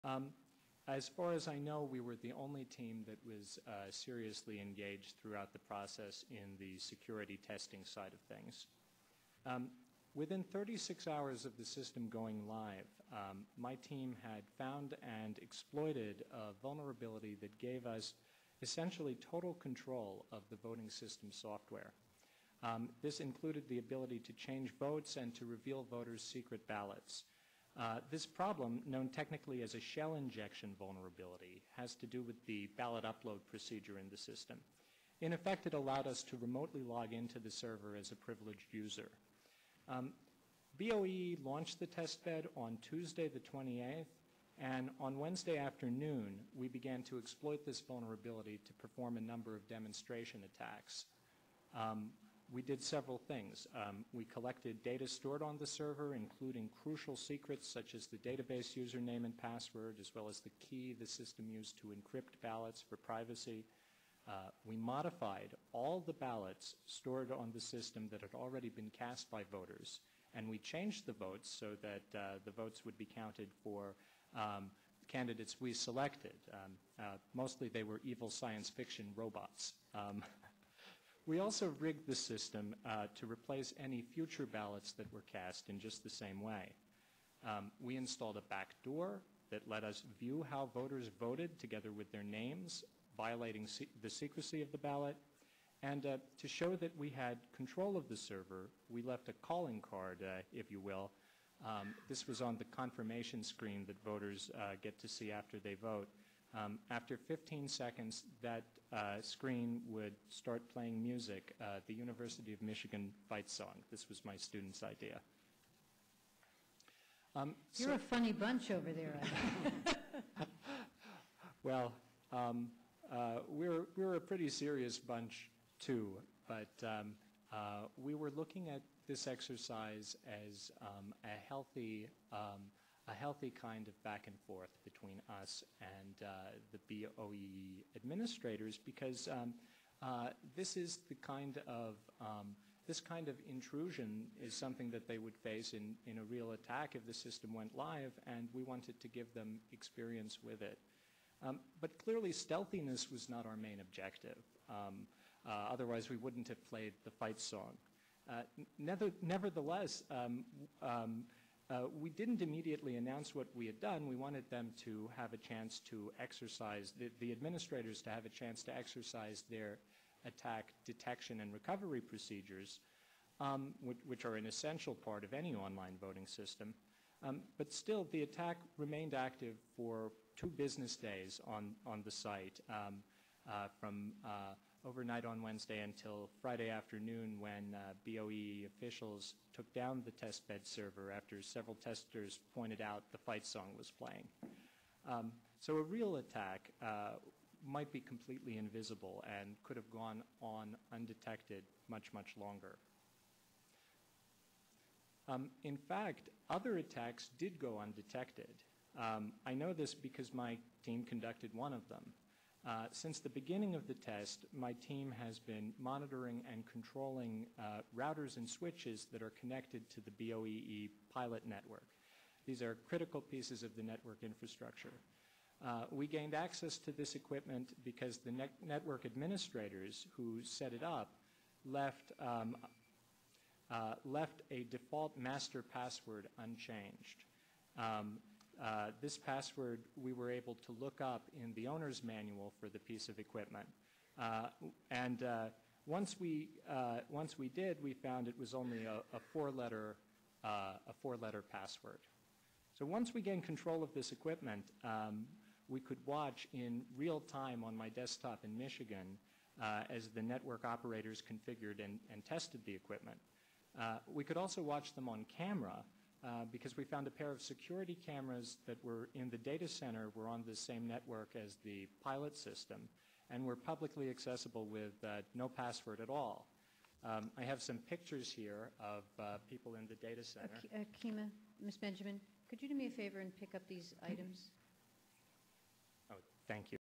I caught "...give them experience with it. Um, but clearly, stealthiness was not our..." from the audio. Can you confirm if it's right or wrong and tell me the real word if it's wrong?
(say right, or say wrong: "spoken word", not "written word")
right.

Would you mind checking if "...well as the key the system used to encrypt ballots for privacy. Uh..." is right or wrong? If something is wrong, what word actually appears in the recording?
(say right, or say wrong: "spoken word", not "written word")
right.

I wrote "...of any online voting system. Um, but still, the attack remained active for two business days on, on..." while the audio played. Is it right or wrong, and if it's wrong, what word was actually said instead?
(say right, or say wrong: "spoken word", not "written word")
right.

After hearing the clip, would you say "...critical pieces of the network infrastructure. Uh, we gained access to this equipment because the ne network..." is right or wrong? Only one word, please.
right.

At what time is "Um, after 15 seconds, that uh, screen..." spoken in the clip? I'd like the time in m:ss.
1:46.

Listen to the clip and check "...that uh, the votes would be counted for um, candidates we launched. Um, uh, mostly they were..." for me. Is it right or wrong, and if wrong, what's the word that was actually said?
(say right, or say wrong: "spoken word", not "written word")
wrong: "selected", not "launched".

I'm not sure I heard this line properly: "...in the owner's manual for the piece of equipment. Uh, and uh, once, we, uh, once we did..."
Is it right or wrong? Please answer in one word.
right.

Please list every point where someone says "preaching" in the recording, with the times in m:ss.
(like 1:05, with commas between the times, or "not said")
not said.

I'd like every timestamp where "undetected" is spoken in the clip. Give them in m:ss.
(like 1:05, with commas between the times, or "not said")
3:20, 3:27.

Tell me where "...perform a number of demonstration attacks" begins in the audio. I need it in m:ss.
0:48.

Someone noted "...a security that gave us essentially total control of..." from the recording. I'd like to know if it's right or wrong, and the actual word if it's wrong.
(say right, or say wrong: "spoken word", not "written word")
wrong: "vulnerability", not "security".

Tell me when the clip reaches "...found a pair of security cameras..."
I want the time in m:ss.
4:26.